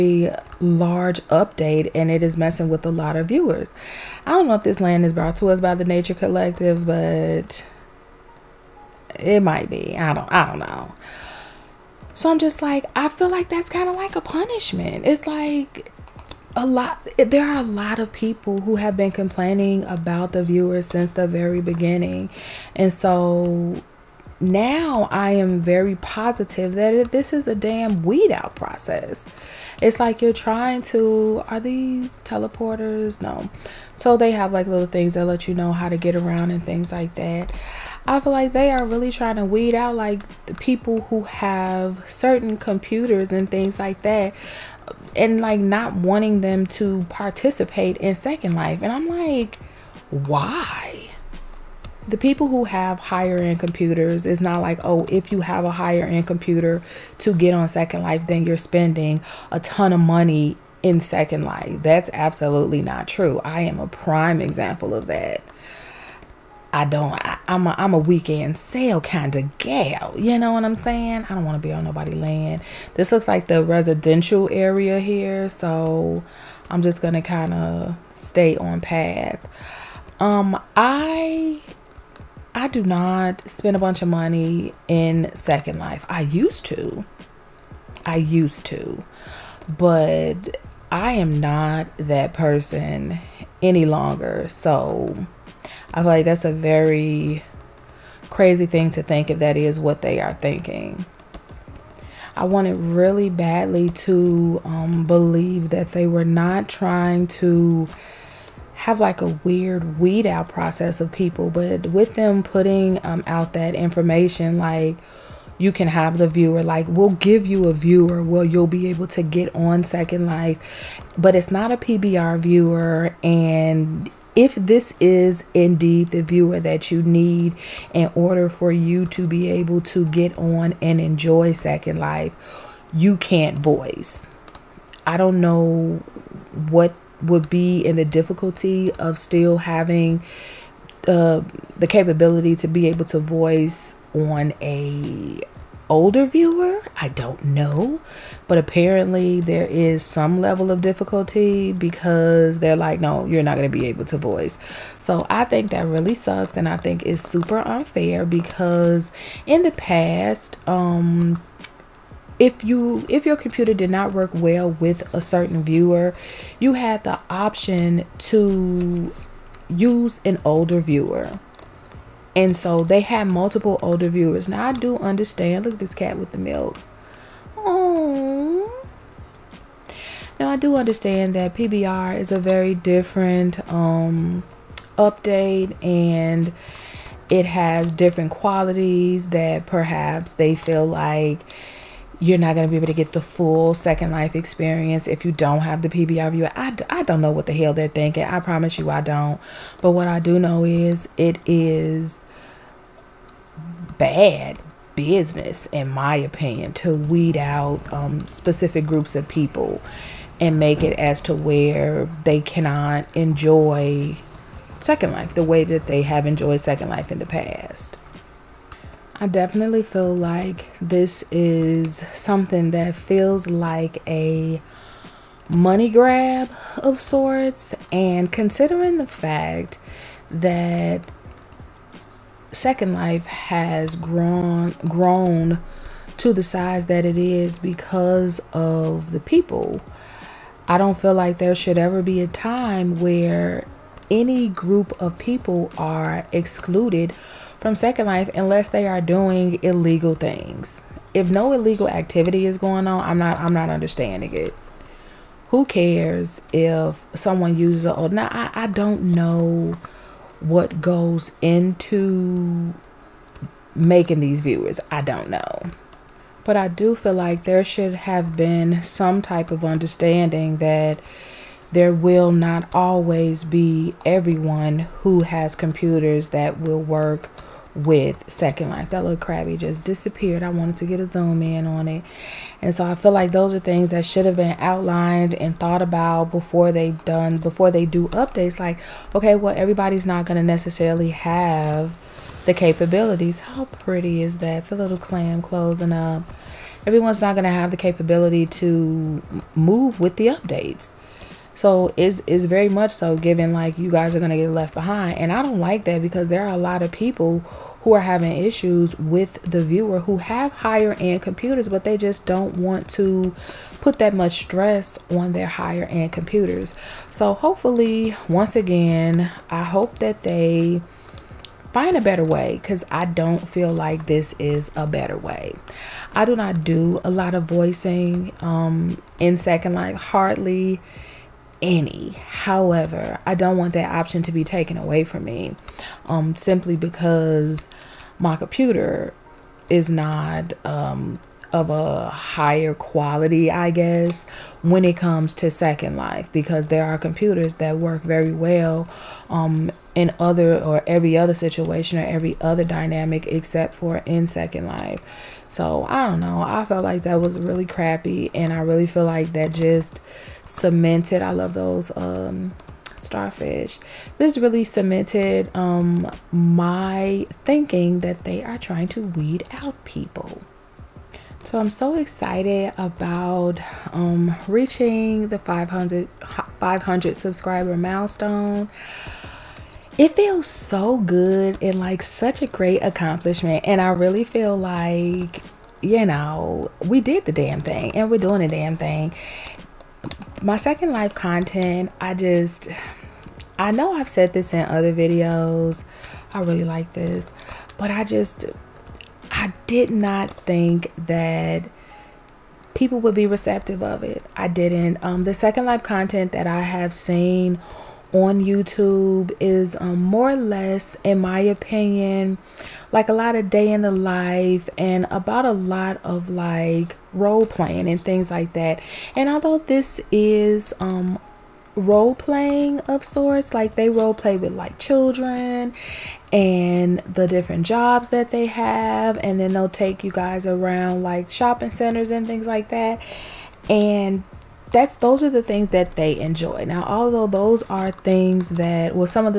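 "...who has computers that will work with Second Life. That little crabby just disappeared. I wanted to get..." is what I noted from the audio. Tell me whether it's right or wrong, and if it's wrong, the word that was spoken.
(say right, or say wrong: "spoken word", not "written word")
right.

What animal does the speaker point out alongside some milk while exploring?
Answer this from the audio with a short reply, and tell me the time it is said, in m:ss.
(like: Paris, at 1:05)
cat, at 2:55.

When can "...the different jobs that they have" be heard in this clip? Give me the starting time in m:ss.
7:06.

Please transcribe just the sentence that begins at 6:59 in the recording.
And although this is um, role playing of sorts.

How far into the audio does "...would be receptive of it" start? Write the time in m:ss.
6:43.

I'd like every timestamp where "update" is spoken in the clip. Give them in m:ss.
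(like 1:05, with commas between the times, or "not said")
0:01, 3:04, 4:48, 5:00.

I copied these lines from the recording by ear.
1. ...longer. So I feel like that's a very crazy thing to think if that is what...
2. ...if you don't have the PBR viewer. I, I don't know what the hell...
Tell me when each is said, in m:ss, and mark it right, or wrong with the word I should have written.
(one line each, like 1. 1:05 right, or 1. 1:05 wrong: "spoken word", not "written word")
1. 1:33 right
2. 3:15 right.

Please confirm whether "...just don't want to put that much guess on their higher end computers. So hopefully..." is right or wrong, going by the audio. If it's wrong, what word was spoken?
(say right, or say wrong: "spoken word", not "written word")
wrong: "stress", not "guess".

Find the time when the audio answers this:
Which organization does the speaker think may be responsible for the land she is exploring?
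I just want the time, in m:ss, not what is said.
0:05.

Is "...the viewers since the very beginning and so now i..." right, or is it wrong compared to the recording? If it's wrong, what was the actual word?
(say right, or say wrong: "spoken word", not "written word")
right.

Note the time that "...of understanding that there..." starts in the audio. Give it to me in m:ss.
4:29.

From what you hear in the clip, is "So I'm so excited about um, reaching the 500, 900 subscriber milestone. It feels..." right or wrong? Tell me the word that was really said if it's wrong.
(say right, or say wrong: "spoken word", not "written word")
wrong: "500", not "900".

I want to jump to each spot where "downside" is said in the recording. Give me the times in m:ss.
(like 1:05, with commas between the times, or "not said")
not said.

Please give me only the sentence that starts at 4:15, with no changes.
Who cares if someone uses a now I, I don't know what goes into making these viewers.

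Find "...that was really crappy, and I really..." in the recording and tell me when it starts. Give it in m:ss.
5:57.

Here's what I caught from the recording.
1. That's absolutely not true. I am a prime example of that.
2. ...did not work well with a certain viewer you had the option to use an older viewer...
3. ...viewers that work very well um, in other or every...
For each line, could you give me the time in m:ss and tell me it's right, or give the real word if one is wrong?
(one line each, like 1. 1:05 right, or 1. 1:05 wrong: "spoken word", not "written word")
1. 1:01 right
2. 2:43 right
3. 5:46 wrong: "computers", not "viewers".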